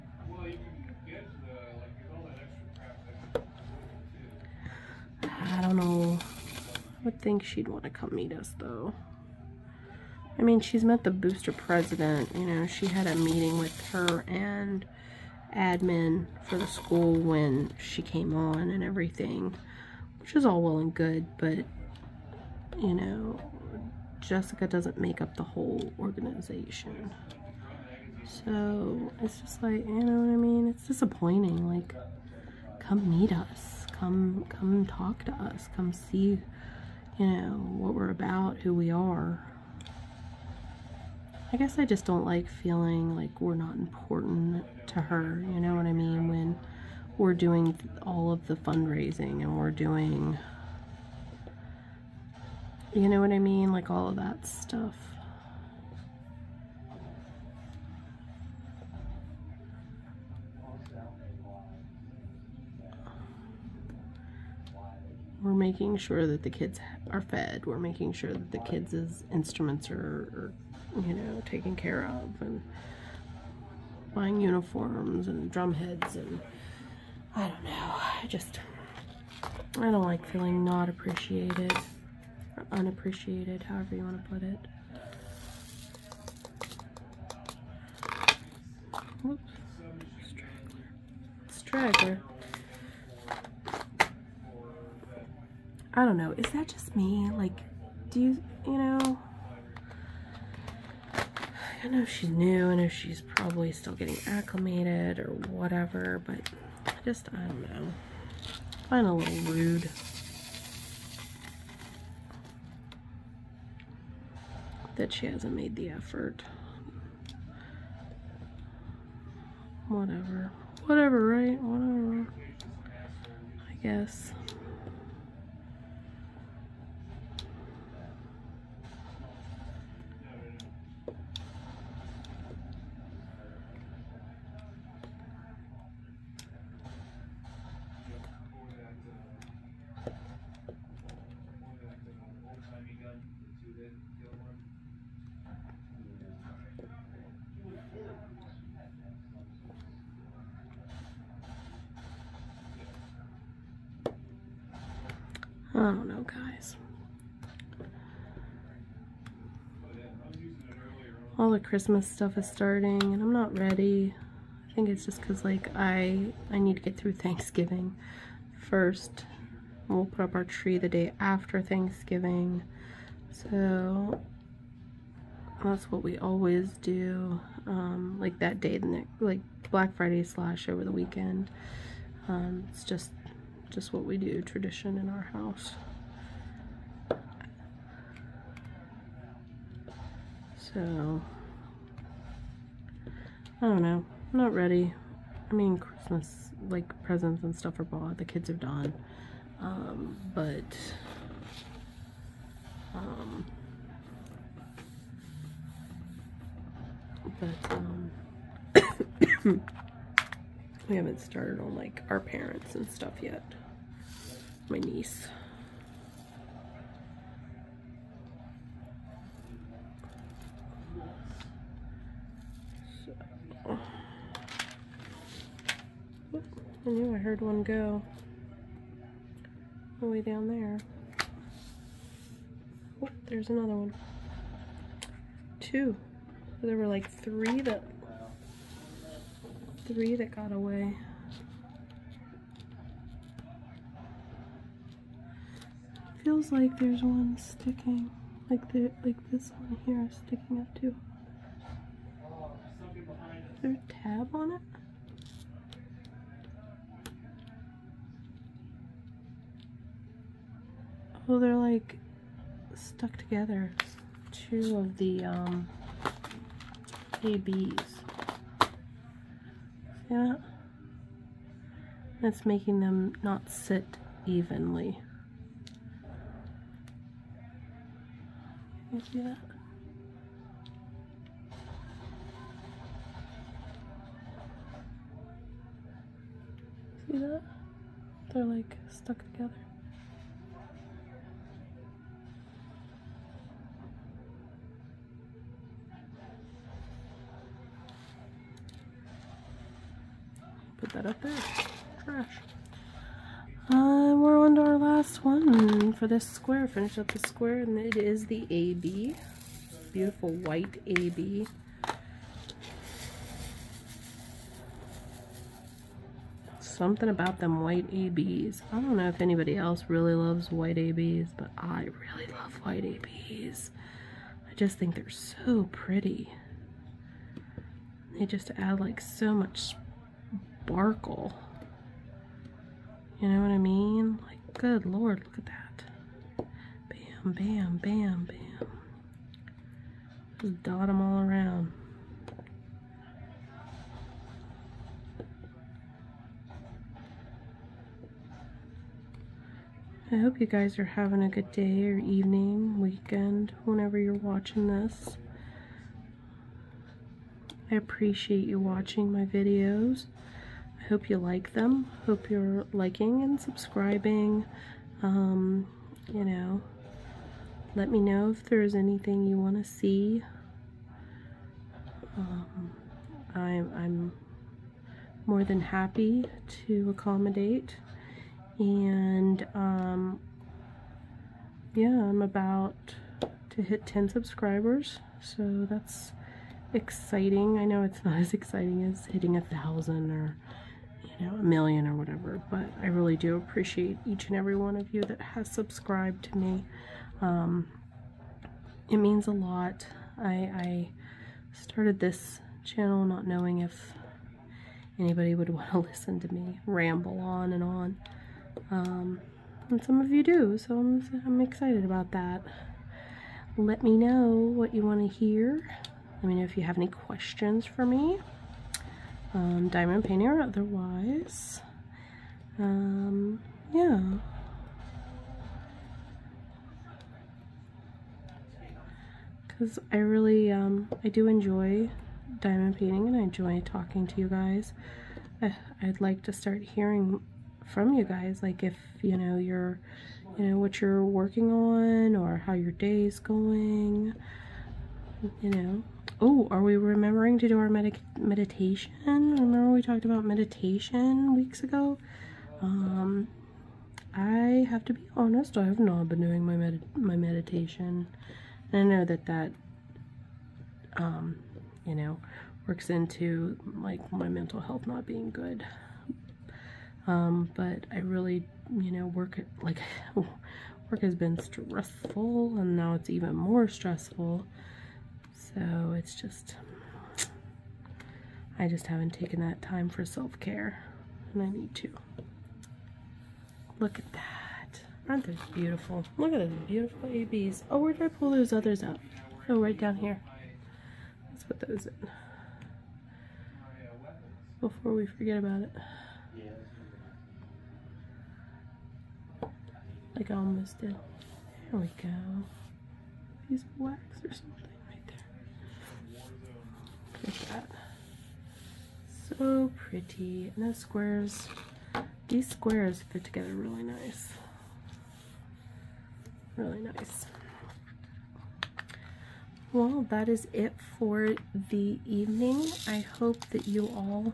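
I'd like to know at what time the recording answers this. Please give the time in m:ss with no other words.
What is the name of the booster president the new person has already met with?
0:24.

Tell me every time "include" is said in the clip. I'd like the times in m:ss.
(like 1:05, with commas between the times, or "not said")
not said.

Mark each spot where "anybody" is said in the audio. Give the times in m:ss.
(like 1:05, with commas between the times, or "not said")
5:19, 6:44.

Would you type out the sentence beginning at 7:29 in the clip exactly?
Remember we talked about meditation weeks ago?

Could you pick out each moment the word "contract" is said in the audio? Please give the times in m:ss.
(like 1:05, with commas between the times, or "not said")
not said.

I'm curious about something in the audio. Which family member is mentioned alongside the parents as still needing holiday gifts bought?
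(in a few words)
niece.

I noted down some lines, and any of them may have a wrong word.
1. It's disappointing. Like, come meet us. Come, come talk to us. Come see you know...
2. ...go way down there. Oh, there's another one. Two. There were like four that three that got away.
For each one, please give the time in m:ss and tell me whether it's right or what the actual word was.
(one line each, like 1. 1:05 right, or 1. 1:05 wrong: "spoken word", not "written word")
1. 0:30 right
2. 3:47 wrong: "three", not "four".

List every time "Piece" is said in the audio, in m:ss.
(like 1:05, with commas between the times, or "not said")
8:23.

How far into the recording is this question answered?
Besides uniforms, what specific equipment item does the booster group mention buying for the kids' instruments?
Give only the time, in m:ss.
1:15.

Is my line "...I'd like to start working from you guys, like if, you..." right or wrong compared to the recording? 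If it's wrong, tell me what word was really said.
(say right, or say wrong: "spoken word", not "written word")
wrong: "hearing", not "working".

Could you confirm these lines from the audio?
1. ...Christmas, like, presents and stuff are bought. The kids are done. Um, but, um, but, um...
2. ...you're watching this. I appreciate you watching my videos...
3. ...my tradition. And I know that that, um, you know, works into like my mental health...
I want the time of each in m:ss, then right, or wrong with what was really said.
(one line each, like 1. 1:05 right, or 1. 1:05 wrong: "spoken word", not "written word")
1. 3:15 right
2. 5:53 right
3. 7:36 wrong: "meditation", not "tradition".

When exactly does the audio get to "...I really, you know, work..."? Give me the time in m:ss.
7:47.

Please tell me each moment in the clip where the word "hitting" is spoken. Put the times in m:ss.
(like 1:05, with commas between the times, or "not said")
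6:29.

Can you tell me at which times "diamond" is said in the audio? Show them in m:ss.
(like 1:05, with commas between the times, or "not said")
6:59, 7:12.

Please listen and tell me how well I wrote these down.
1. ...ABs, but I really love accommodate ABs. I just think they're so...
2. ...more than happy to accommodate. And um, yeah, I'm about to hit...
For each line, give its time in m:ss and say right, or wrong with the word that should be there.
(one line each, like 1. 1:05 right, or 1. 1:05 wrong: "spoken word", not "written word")
1. 5:20 wrong: "white", not "accommodate"
2. 6:15 right.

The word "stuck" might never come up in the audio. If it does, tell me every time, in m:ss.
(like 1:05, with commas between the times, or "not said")
4:22, 4:48.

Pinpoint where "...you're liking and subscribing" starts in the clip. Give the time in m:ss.
6:02.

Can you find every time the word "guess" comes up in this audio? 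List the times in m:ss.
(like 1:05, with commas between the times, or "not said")
0:41, 2:03.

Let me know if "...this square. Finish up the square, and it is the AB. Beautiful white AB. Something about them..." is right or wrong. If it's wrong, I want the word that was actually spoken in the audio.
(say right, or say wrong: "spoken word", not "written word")
right.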